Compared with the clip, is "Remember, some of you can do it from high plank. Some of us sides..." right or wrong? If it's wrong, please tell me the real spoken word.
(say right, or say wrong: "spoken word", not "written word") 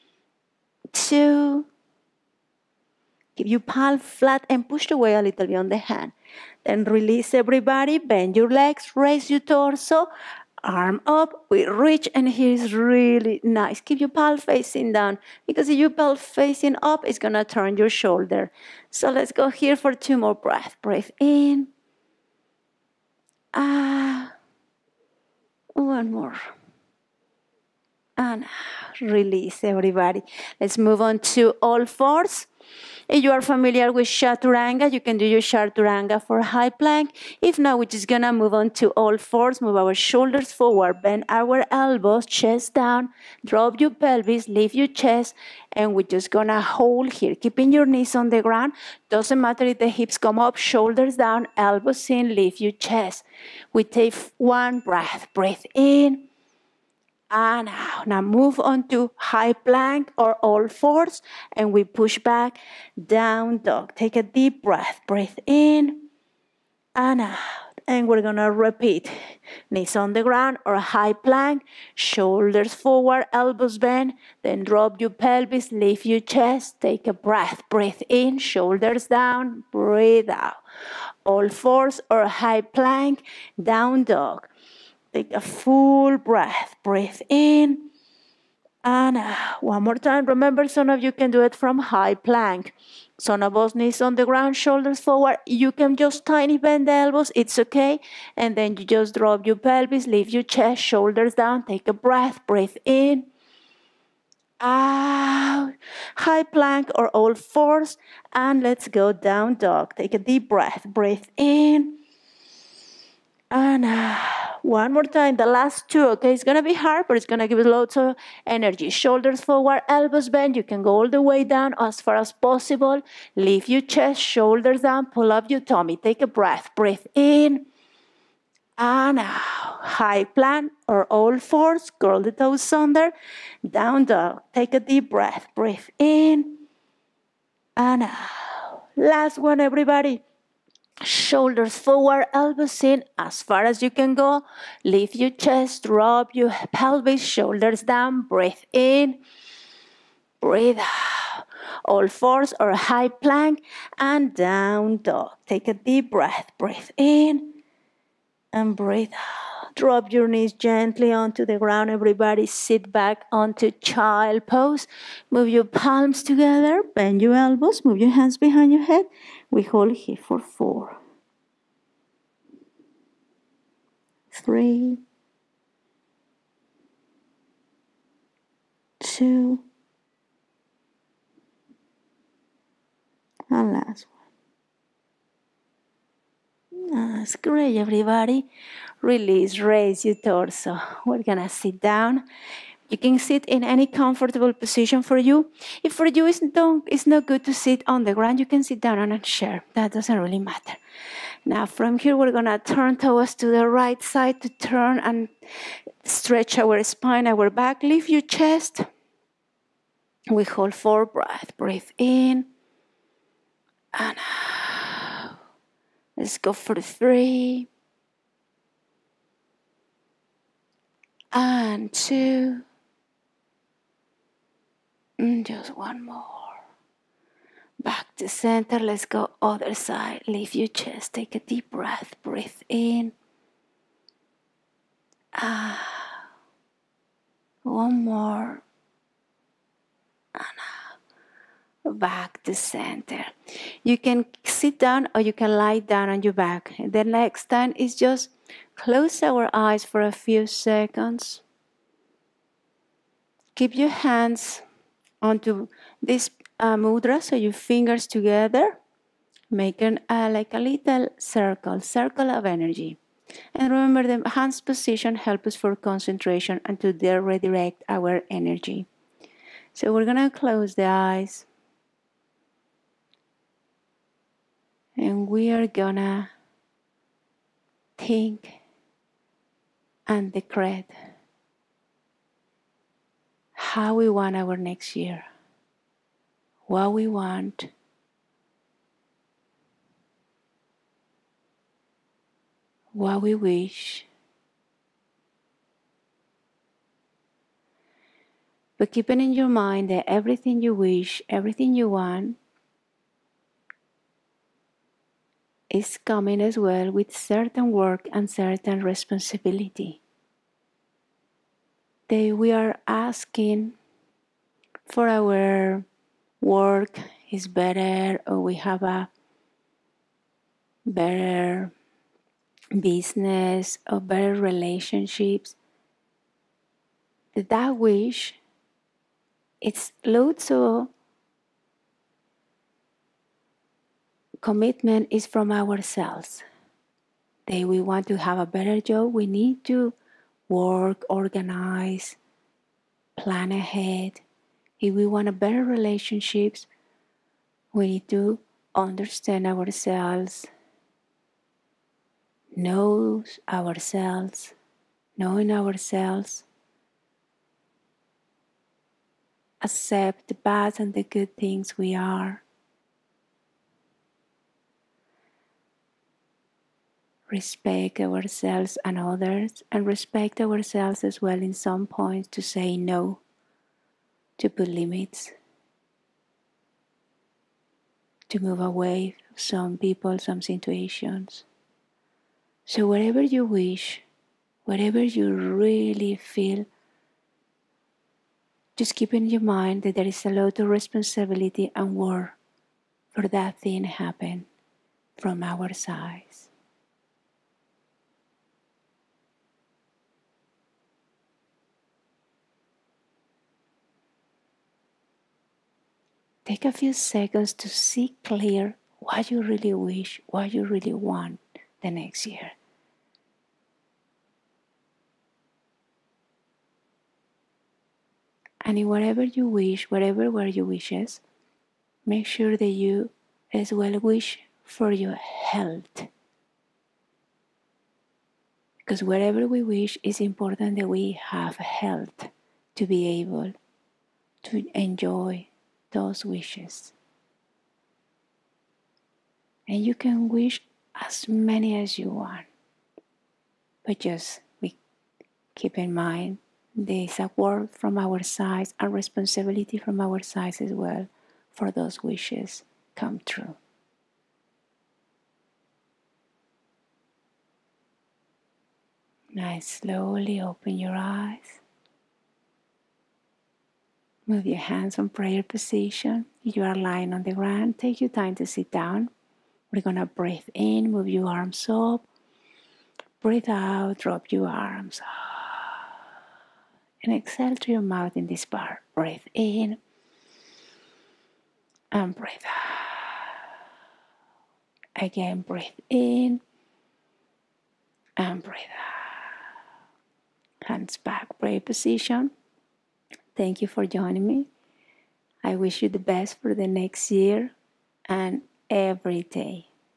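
wrong: "knees", not "sides".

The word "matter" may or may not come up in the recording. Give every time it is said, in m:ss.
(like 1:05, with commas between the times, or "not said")
0:49, 3:20.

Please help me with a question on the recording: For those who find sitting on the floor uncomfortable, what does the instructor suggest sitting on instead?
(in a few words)
A chair.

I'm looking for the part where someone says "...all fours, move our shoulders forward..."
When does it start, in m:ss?
0:38.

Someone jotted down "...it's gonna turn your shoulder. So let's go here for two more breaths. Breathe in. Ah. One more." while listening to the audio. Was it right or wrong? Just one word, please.
right.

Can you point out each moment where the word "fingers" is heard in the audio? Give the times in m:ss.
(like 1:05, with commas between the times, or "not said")
4:17.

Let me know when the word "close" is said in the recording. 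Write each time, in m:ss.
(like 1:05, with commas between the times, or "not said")
4:08, 4:30.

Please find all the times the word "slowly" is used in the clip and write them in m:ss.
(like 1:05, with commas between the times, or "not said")
7:39.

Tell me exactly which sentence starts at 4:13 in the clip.
Keep your hands onto this uh, mudra.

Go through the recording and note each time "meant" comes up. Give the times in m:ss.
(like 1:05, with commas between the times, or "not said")
not said.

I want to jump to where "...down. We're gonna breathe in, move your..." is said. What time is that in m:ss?
7:48.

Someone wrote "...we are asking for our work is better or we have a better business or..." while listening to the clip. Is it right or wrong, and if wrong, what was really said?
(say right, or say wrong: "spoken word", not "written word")
right.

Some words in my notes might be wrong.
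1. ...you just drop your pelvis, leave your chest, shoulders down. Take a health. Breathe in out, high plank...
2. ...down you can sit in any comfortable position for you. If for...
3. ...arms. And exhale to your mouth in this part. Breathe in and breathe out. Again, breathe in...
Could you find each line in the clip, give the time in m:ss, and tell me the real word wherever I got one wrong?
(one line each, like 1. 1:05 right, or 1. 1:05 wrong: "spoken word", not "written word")
1. 1:38 wrong: "breath", not "health"
2. 3:11 right
3. 7:54 right.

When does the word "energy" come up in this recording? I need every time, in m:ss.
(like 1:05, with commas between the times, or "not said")
1:58, 4:22, 4:28.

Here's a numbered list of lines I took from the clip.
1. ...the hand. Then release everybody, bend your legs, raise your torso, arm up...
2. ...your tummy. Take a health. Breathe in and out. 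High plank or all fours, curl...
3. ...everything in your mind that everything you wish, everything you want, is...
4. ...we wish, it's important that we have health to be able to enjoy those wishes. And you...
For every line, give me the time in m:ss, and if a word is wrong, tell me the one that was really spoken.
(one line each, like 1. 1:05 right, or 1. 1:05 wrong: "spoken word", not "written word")
1. 0:05 right
2. 2:05 wrong: "breath", not "health"
3. 4:58 wrong: "keeping", not "everything"
4. 7:09 right.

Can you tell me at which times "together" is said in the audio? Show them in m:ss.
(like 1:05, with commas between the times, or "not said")
2:46, 4:18.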